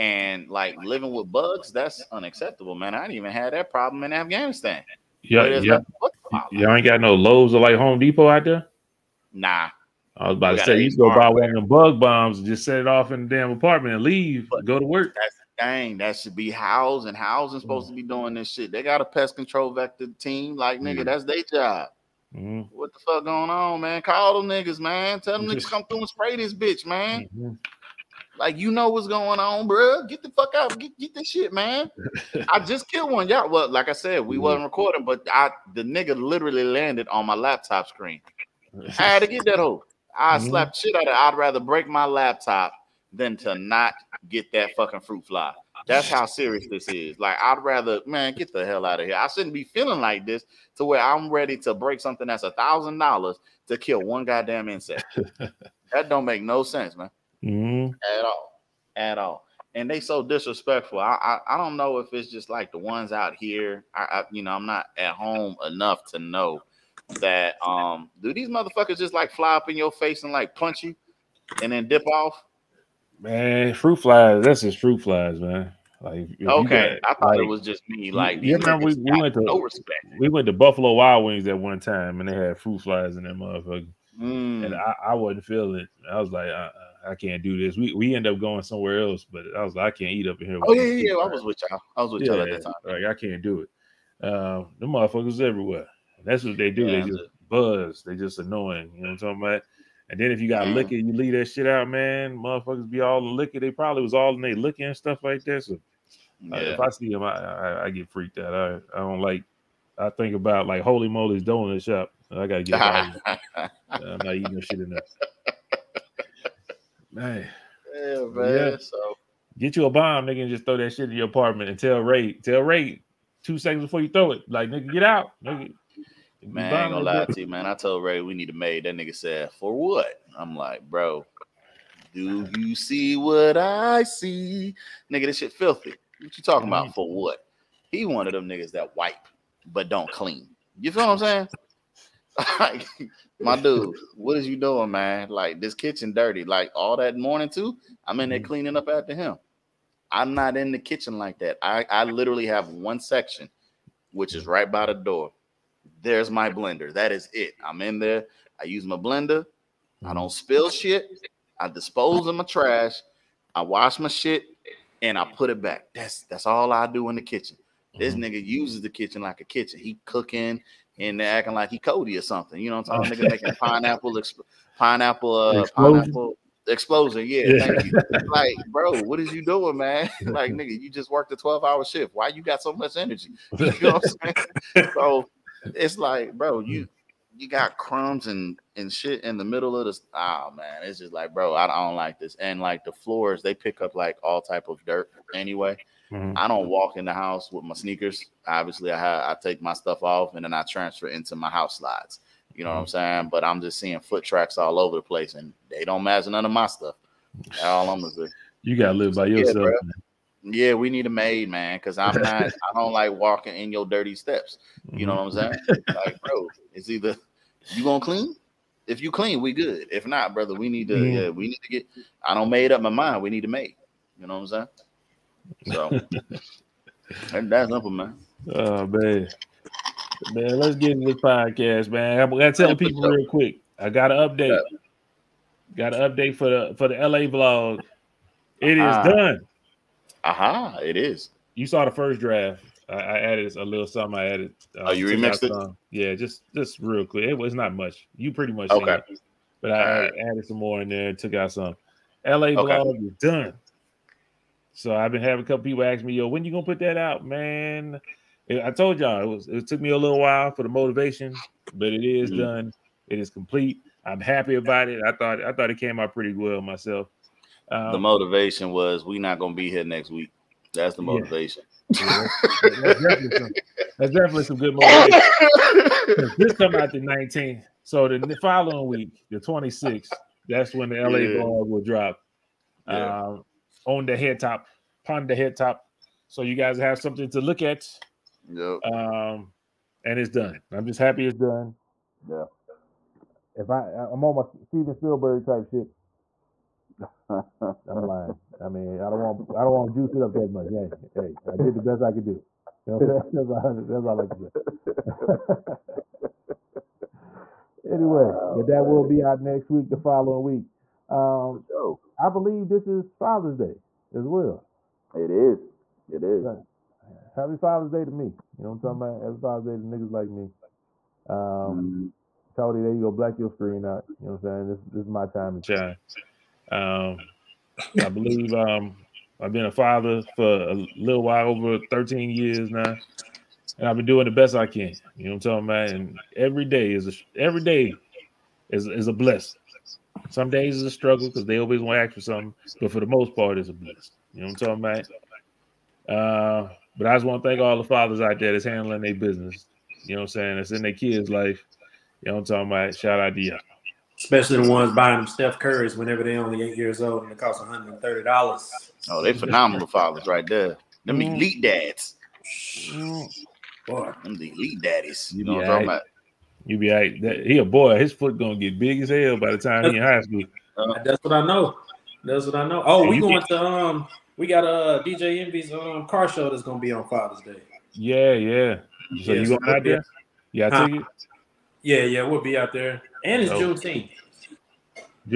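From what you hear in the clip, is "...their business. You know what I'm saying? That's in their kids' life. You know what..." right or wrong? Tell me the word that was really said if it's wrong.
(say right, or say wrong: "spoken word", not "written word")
right.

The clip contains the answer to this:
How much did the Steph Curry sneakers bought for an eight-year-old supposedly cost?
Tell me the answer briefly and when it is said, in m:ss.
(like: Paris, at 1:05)
$130, at 5:57.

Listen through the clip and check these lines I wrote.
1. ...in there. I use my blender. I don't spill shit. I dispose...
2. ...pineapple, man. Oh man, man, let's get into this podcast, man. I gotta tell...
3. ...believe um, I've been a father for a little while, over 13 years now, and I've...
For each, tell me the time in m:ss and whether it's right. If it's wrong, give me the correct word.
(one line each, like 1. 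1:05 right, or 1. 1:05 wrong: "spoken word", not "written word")
1. 2:37 right
2. 3:47 wrong: "simple", not "pineapple"
3. 5:28 right.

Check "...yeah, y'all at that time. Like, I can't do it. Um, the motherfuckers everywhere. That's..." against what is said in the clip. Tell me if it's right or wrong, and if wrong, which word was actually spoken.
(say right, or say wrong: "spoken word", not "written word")
right.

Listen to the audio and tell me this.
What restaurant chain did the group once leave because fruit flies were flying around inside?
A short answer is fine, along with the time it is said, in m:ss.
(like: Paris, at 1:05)
Buffalo Wild Wings, at 1:20.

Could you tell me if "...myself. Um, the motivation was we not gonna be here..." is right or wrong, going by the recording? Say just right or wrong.
right.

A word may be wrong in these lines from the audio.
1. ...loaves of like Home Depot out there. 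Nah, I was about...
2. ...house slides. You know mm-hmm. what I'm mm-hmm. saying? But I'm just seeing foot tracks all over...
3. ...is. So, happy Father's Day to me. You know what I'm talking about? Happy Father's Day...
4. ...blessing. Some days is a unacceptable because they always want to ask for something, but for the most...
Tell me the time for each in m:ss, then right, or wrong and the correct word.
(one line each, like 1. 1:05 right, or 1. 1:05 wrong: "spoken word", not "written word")
1. 0:07 right
2. 3:21 right
3. 5:16 right
4. 5:39 wrong: "struggle", not "unacceptable".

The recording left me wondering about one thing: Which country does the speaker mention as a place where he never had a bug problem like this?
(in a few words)
Afghanistan.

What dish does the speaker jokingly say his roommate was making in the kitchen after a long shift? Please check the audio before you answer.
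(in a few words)
Pineapple explosion.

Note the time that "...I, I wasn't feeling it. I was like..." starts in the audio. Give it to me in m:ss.
1:24.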